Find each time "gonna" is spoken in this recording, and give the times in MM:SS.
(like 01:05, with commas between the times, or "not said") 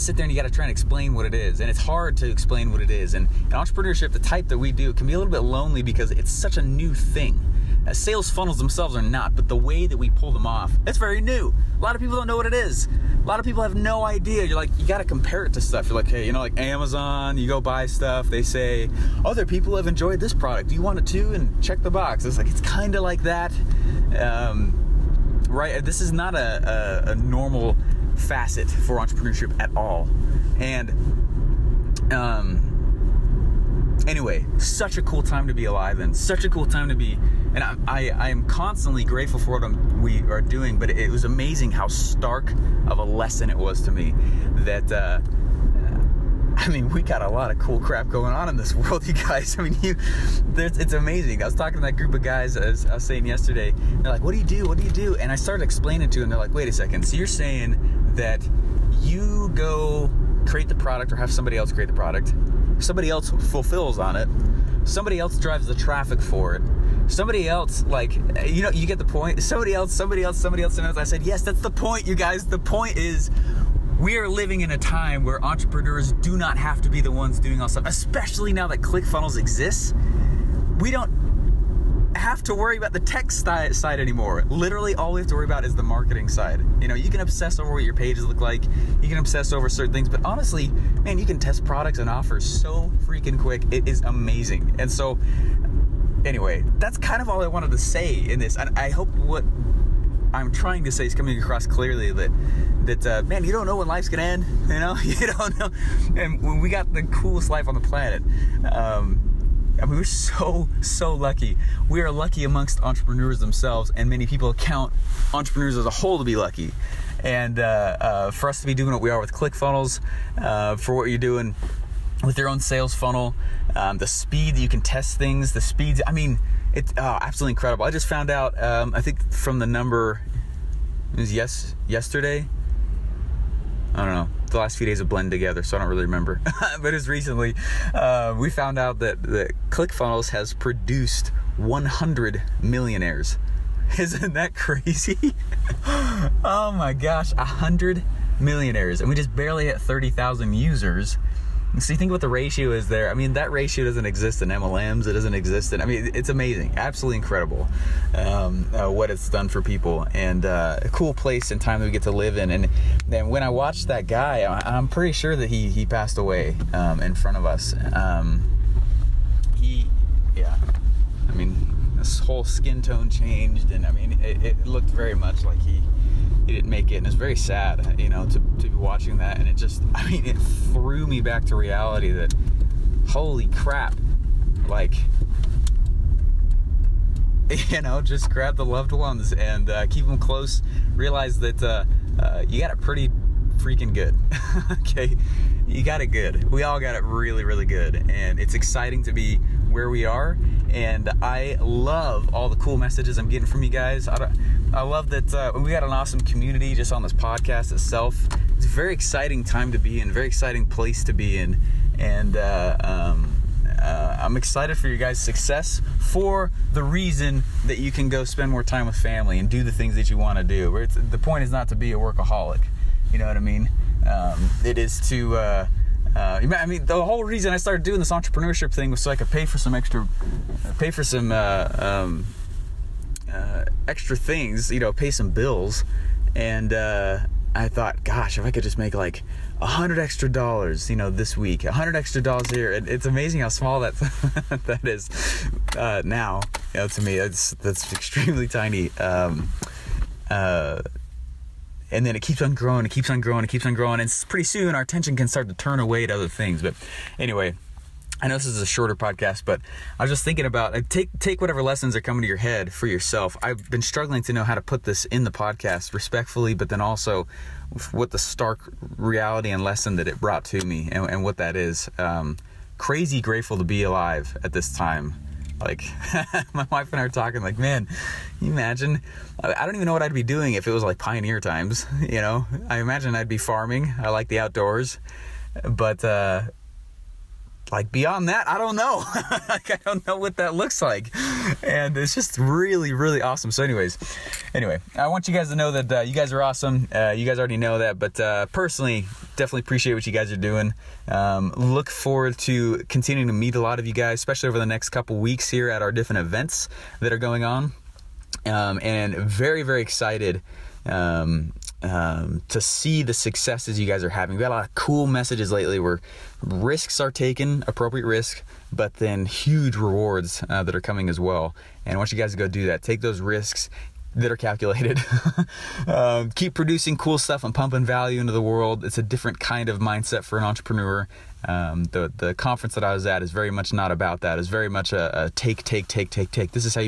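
01:44.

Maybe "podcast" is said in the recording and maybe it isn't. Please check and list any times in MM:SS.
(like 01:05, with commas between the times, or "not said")
03:27, 04:18, 04:25.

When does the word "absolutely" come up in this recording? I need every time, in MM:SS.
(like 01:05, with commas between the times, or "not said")
02:07, 02:36.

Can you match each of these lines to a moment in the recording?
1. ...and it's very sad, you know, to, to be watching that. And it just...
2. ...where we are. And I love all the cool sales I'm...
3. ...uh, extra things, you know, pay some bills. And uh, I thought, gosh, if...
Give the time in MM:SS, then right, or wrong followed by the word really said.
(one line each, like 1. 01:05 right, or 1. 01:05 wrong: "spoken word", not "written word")
1. 02:56 right
2. 03:19 wrong: "messages", not "sales"
3. 03:53 right.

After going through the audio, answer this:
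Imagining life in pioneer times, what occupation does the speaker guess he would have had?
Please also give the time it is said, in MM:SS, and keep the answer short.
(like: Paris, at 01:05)
Farming, at 04:43.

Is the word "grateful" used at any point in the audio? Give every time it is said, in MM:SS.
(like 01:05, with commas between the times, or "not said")
00:39, 04:33.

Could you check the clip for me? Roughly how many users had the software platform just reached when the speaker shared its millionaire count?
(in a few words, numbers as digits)
30,000.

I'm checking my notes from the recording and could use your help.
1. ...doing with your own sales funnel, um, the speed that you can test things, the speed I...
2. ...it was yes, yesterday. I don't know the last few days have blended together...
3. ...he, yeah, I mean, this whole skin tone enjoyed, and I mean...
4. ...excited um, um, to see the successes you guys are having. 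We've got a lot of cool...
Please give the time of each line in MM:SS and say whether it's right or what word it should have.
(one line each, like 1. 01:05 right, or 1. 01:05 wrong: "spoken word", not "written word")
1. 02:01 right
2. 02:11 right
3. 02:49 wrong: "changed", not "enjoyed"
4. 05:09 right.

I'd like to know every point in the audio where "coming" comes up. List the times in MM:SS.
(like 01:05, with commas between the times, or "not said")
01:41, 04:22, 05:20.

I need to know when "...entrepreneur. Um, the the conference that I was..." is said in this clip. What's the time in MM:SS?
05:30.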